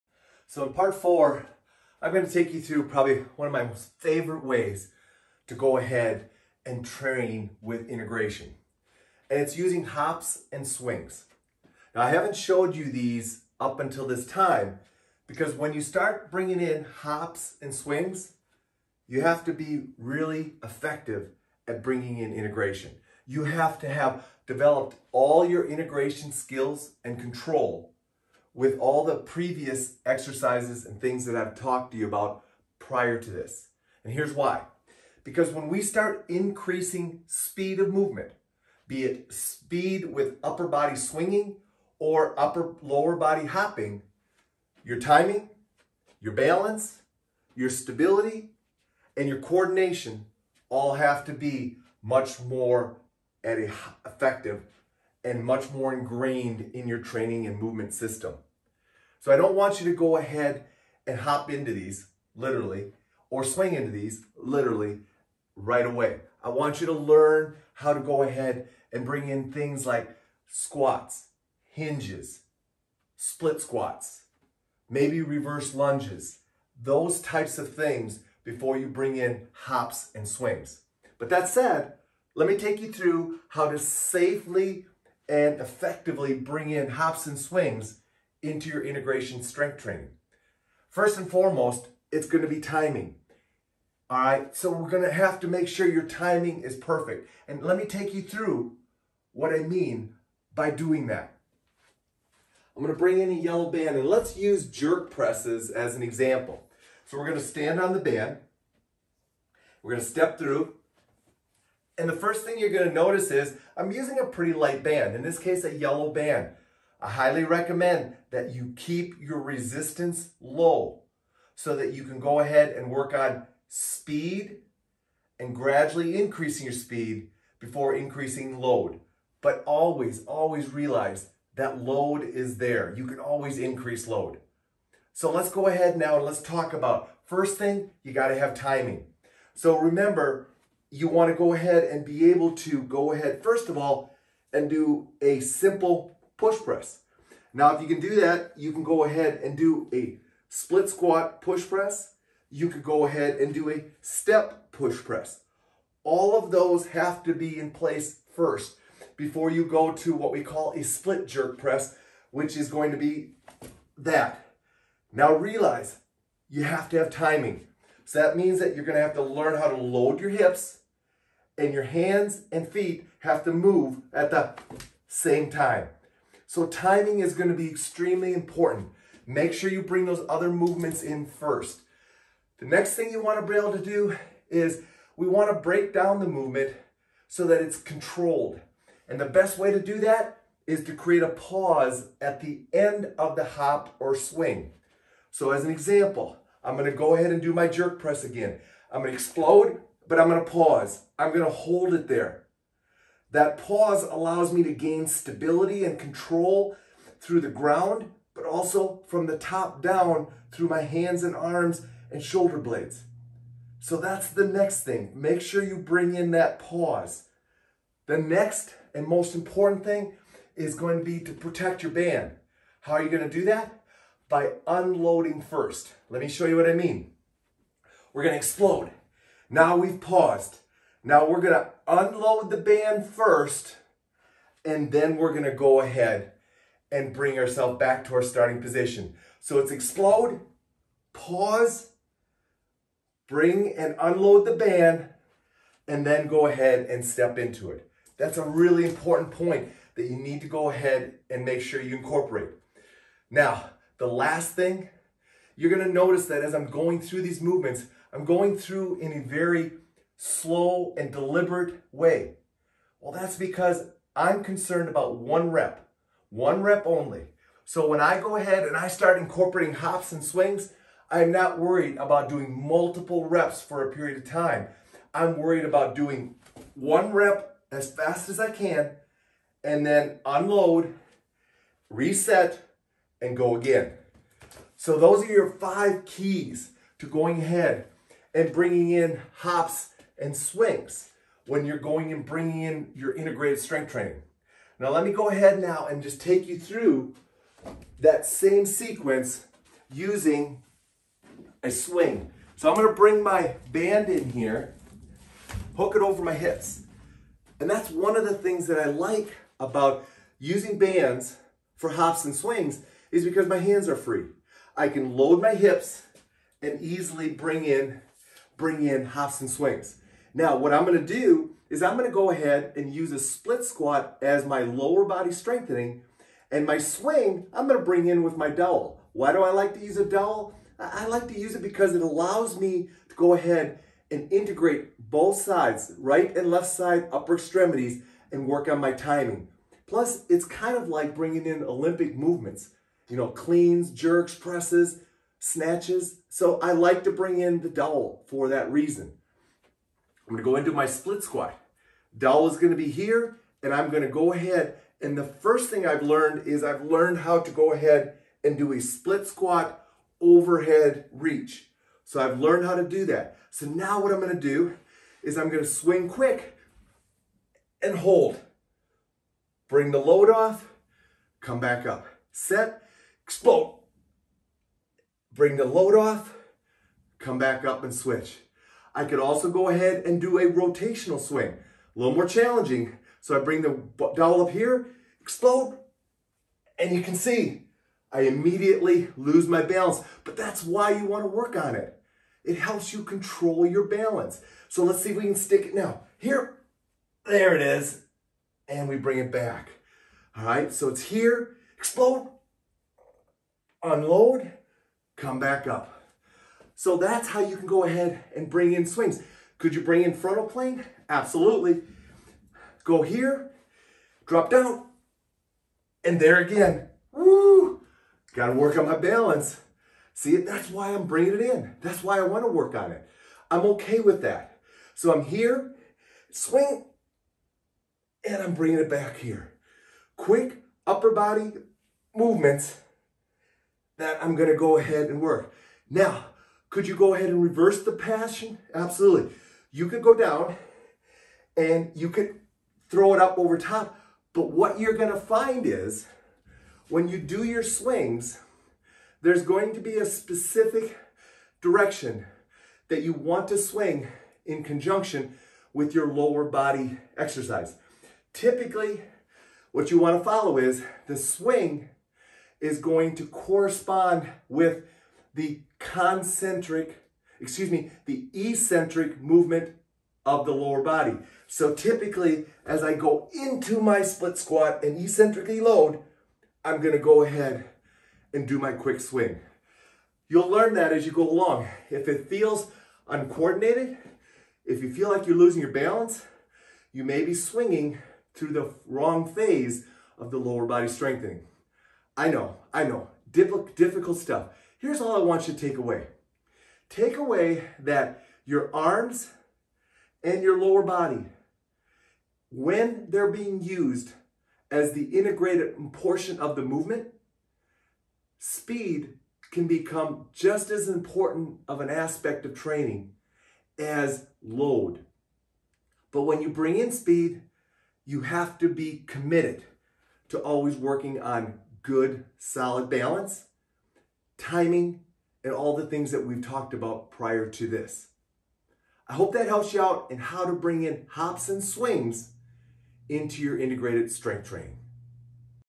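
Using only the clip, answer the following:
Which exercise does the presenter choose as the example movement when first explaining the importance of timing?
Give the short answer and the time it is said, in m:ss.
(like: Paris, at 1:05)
Jerk presses, at 1:44.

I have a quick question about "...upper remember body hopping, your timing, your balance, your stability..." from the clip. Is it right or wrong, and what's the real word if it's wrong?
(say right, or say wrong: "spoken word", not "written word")
wrong: "lower", not "remember".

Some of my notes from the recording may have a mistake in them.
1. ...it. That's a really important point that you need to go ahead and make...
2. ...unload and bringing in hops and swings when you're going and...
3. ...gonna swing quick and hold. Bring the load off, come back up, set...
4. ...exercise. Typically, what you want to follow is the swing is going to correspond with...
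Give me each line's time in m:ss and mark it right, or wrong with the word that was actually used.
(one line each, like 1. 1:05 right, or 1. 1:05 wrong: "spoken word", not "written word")
1. 4:07 right
2. 4:47 wrong: "ahead", not "unload"
3. 6:05 right
4. 7:37 right.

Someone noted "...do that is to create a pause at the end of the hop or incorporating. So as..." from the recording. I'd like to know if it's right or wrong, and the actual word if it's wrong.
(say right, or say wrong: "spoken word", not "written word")
wrong: "swing", not "incorporating".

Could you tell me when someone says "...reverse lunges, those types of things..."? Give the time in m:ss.
1:15.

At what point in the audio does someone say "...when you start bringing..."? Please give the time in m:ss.
0:15.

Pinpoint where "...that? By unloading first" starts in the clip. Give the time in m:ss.
3:43.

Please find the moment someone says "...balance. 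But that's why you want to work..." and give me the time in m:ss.
6:29.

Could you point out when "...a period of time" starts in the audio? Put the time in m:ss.
4:33.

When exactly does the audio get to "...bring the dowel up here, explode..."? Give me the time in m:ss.
6:23.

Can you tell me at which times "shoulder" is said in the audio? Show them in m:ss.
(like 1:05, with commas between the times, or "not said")
3:32.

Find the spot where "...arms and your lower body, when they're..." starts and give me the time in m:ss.
8:18.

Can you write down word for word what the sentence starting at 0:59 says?
So I don't want you to go ahead and hop into these literally or swing into these literally right away.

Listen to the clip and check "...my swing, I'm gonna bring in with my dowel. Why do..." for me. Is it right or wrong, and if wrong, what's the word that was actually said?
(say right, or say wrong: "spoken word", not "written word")
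right.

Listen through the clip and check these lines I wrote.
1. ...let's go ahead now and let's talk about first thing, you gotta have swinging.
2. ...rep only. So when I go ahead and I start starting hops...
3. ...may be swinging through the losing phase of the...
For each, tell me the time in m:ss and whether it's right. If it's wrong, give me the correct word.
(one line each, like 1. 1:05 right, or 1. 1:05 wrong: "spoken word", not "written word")
1. 2:15 wrong: "timing", not "swinging"
2. 4:26 wrong: "incorporating", not "starting"
3. 8:07 wrong: "wrong", not "losing".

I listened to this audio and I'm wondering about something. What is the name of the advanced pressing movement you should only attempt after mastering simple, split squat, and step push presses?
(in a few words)
Split jerk press.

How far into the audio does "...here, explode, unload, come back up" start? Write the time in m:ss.
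6:41.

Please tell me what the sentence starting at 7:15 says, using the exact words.
Now, could you go ahead and reverse the passion?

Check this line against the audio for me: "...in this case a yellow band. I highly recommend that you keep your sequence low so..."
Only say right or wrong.
wrong.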